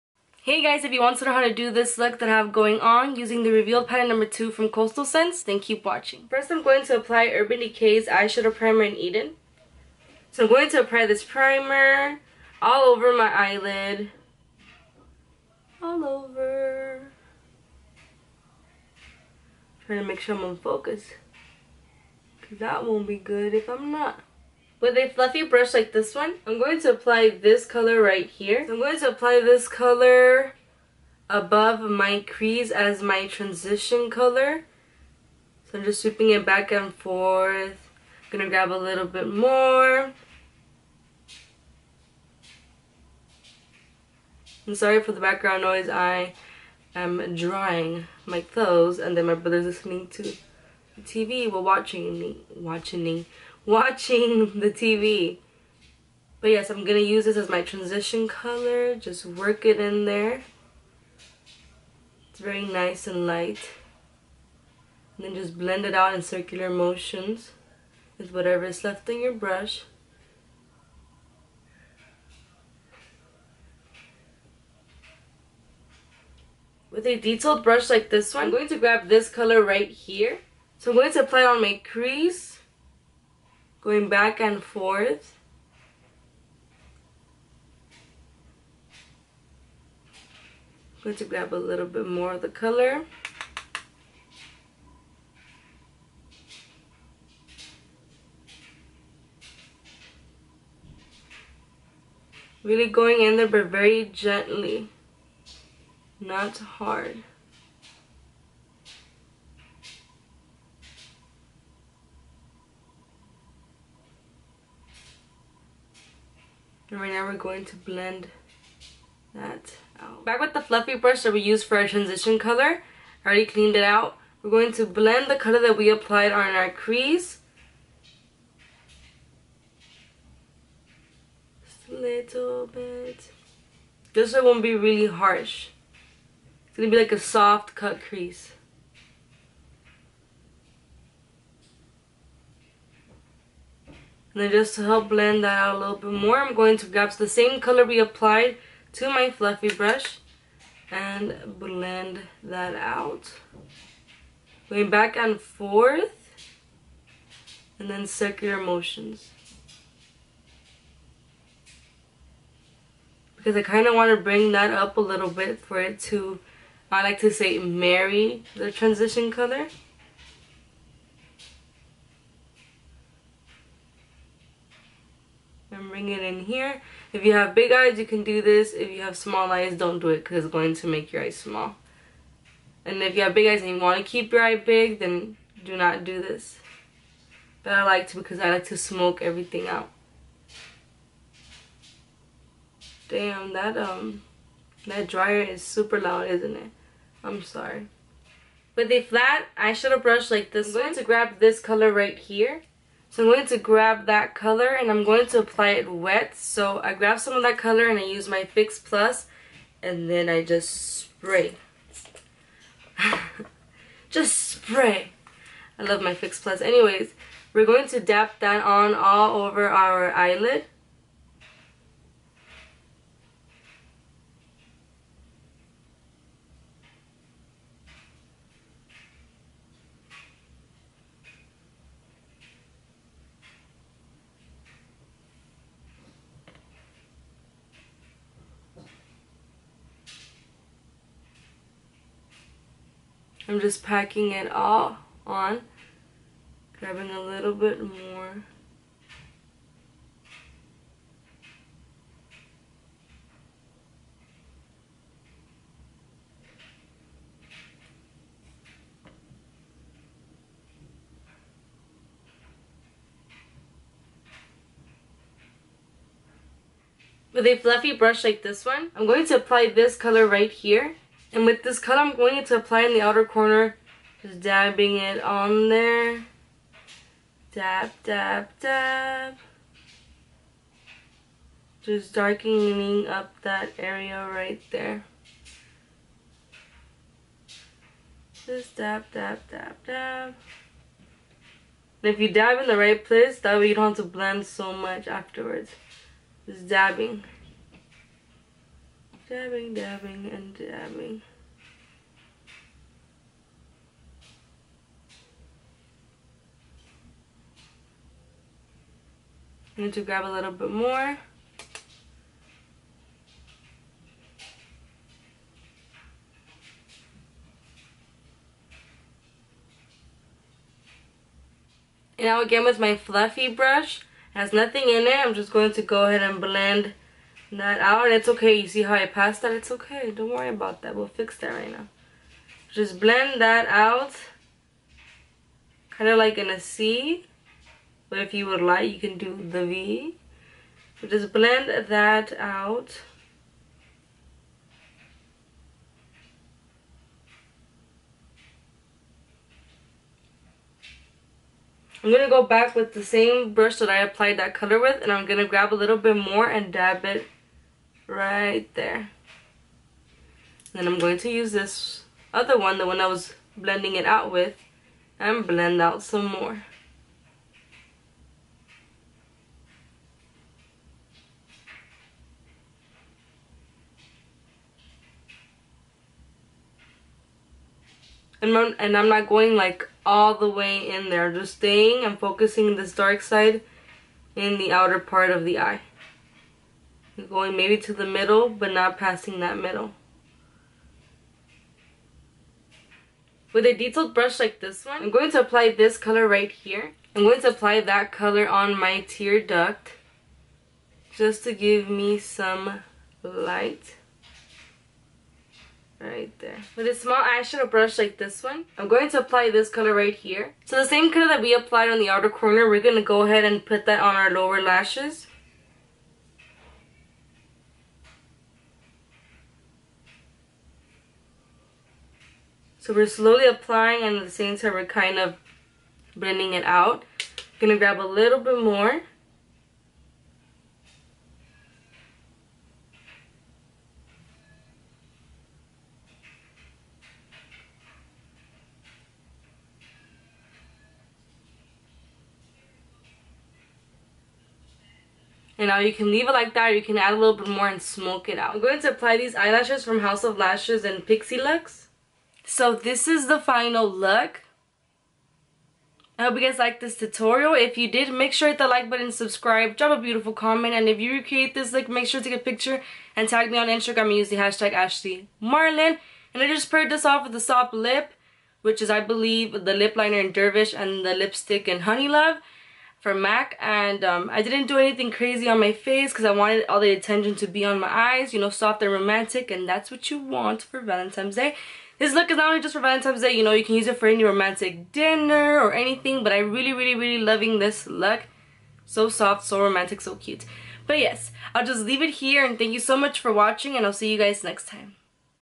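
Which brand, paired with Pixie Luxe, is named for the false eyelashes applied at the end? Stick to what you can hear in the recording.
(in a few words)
House of Lashes.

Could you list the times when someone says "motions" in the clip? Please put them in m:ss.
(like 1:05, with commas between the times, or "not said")
1:06, 2:38.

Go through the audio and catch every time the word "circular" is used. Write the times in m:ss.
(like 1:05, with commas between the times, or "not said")
1:06, 2:38.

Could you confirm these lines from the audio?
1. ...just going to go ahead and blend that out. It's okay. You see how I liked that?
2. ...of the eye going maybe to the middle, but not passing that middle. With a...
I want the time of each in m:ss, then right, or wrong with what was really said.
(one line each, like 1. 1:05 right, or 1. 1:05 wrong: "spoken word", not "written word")
1. 5:25 wrong: "passed", not "liked"
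2. 6:25 right.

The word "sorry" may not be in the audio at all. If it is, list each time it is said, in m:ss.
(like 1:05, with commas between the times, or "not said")
0:44, 3:17.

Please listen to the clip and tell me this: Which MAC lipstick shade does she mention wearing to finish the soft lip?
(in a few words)
Honey Love.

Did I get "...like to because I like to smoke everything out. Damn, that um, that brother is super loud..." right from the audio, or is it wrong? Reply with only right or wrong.
wrong.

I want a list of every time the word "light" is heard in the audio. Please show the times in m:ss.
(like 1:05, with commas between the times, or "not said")
1:03, 6:43.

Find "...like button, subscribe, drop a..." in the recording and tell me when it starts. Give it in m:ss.
7:38.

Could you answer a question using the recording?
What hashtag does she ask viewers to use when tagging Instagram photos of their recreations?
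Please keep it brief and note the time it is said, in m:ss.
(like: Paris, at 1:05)
Ashley Marlen, at 7:44.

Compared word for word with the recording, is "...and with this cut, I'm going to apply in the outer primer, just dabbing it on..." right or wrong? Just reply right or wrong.
wrong.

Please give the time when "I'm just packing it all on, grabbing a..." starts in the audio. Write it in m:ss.
4:03.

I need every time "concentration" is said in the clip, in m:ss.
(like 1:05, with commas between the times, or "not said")
not said.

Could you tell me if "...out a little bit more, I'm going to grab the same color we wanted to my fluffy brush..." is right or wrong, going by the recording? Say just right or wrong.
wrong.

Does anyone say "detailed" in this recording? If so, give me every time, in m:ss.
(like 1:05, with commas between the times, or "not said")
1:17, 6:33.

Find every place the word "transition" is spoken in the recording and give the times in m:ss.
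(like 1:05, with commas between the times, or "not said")
0:33, 0:57, 2:01, 2:48.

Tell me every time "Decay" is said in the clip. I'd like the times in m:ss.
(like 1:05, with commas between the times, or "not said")
0:07.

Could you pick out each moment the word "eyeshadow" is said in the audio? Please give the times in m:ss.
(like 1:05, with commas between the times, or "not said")
0:08, 3:19, 6:47.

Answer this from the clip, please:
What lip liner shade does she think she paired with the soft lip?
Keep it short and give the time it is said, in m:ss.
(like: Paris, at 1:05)
Dervish, at 7:50.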